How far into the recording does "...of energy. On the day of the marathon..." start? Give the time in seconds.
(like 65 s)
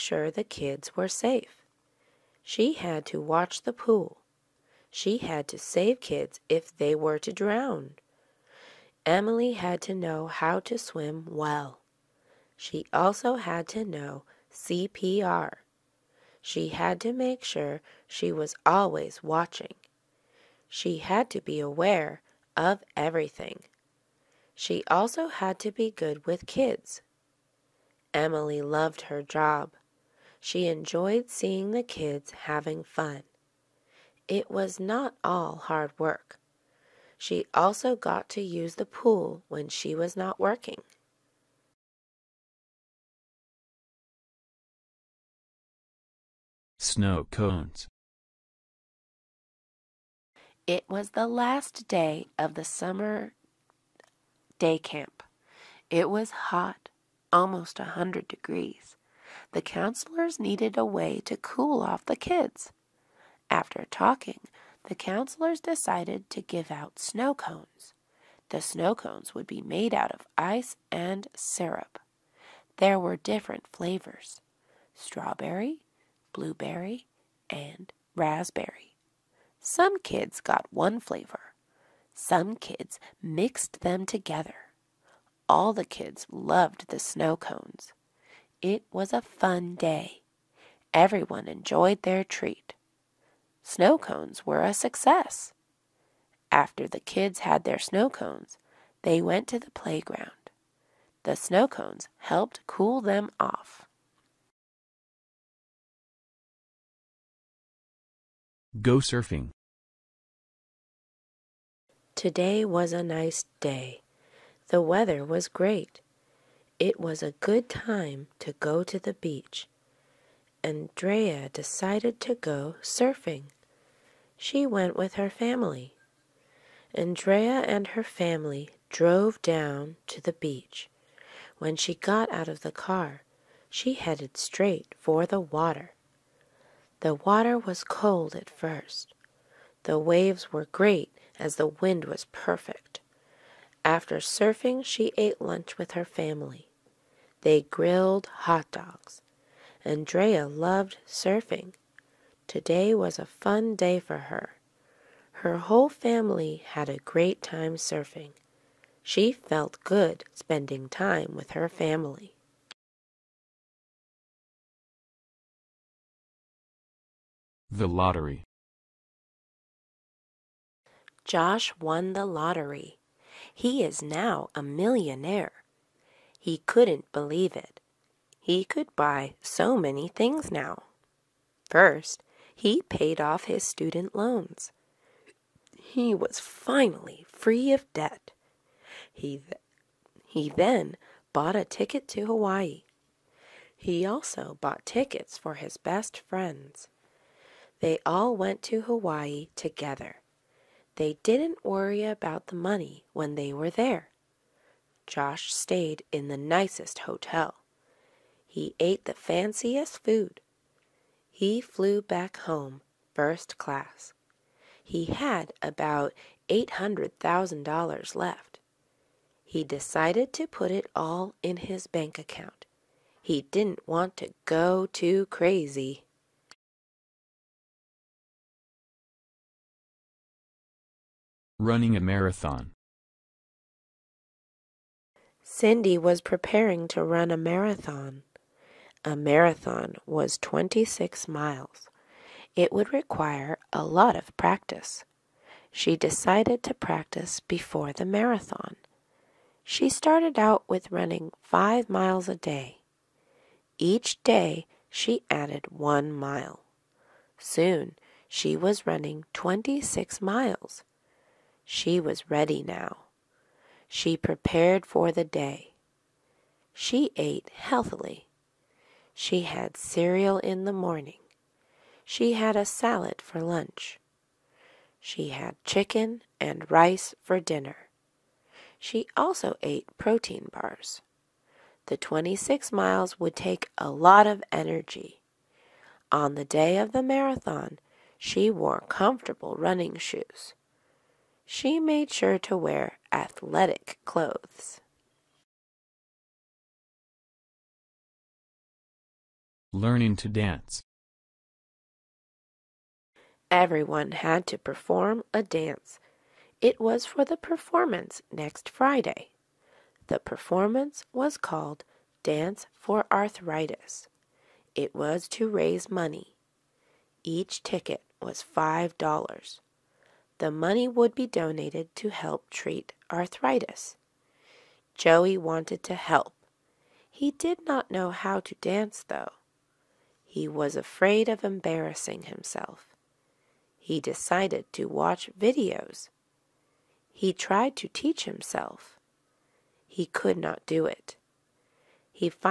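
284 s.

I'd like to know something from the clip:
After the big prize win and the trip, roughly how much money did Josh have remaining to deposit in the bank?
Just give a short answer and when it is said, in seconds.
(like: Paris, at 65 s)
$800,000, at 216 s.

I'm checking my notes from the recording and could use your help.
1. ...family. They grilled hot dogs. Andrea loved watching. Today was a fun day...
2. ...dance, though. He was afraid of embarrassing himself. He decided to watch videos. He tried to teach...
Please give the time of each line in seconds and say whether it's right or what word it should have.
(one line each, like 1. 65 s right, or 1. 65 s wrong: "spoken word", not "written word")
1. 146 s wrong: "surfing", not "watching"
2. 328 s right.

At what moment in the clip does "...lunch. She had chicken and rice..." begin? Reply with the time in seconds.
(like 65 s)
273 s.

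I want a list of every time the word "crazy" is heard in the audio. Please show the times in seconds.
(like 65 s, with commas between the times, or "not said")
225 s.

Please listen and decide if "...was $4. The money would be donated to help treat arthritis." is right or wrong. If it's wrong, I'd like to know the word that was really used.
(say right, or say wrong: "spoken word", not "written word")
wrong: "5", not "4".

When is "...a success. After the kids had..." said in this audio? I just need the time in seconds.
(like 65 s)
94 s.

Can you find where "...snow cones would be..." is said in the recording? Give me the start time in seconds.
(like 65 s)
68 s.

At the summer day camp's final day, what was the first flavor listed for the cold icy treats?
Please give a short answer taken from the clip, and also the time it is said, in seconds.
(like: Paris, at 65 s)
strawberry, at 74 s.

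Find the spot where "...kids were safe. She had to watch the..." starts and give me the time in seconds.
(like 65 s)
0 s.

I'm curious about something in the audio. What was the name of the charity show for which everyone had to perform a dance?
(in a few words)
Dance for Arthritis.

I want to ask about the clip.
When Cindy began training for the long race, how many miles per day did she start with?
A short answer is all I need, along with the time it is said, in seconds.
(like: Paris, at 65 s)
5, at 251 s.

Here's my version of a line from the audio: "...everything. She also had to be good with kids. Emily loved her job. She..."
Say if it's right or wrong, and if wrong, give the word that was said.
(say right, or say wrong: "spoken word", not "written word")
right.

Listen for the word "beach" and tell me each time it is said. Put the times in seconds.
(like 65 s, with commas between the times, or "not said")
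119 s, 130 s.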